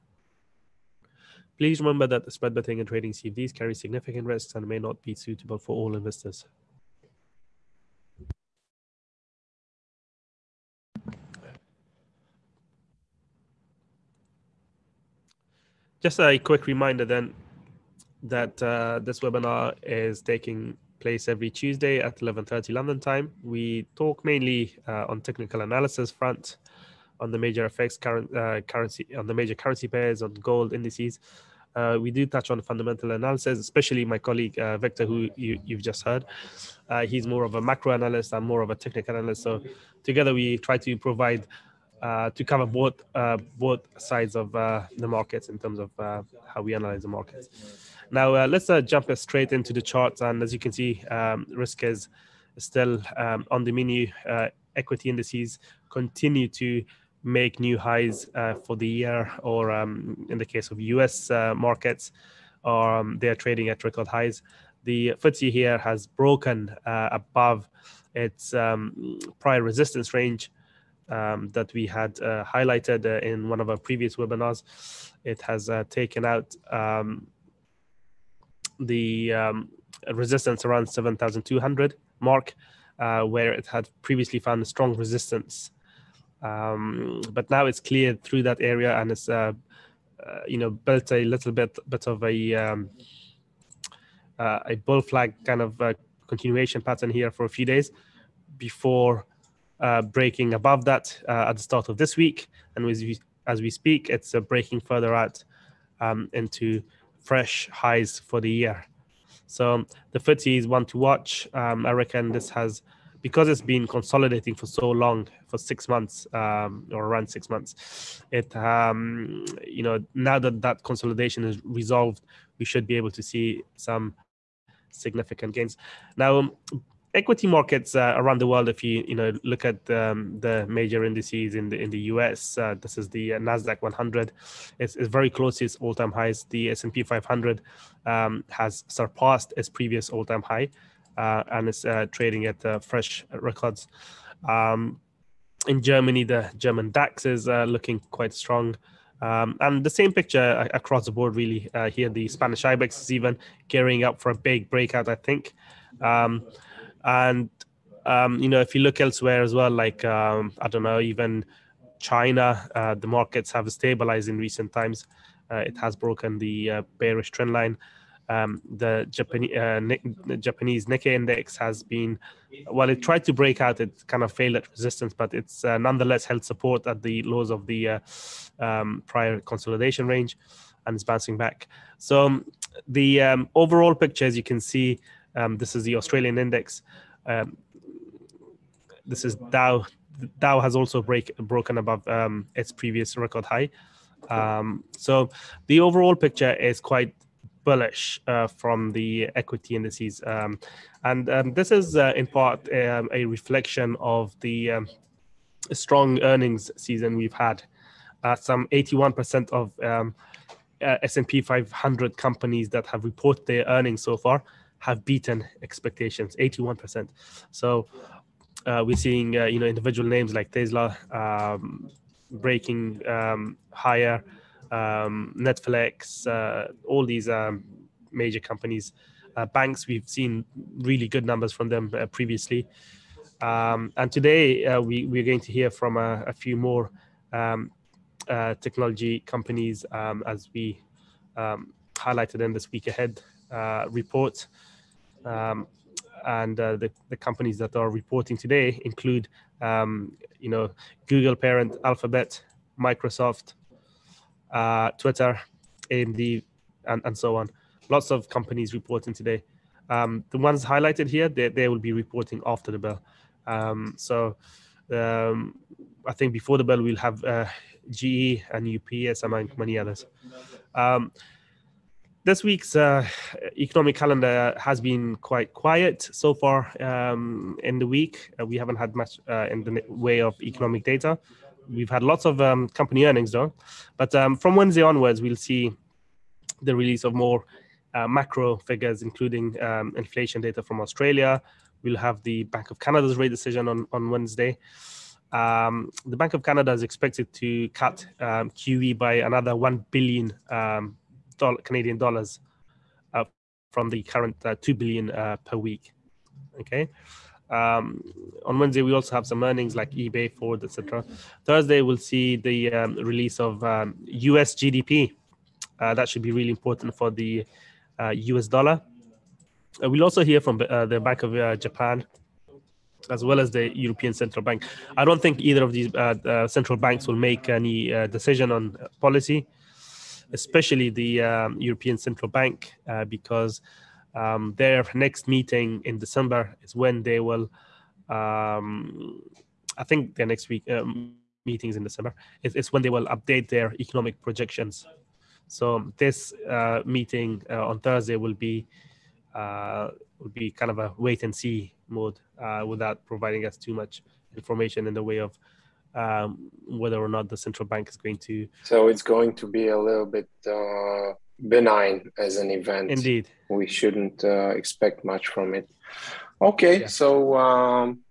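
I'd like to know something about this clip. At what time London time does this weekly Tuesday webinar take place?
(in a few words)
11:30.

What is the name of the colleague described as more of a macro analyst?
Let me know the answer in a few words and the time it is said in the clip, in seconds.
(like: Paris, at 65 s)
Victor, at 34 s.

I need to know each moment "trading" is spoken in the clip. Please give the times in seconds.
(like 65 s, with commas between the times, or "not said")
2 s, 63 s, 142 s.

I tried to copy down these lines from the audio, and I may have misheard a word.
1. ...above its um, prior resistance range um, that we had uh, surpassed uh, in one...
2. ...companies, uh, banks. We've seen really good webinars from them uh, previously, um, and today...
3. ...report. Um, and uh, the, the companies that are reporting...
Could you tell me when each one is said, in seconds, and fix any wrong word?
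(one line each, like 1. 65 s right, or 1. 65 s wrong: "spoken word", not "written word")
1. 66 s wrong: "highlighted", not "surpassed"
2. 228 s wrong: "numbers", not "webinars"
3. 243 s right.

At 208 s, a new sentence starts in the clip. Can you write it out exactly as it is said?
Uh, some 81% of um, uh, S&P 500 companies that have reported their earnings so far have beaten expectations, 81%.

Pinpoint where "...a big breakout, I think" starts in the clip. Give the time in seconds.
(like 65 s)
154 s.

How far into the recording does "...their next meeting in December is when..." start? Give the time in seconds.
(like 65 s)
334 s.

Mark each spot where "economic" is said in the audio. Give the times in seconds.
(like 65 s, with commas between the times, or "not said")
273 s, 280 s, 343 s.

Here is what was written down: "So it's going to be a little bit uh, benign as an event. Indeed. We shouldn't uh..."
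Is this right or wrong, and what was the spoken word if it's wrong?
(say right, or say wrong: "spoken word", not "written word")
right.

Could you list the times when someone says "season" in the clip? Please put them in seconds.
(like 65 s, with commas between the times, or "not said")
206 s.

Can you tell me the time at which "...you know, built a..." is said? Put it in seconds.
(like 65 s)
90 s.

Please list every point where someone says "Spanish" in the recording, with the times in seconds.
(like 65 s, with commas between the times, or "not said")
152 s.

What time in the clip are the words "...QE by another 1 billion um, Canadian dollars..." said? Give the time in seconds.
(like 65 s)
298 s.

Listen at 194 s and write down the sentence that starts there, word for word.
Um, so the overall picture is quite bullish uh, from the equity indices.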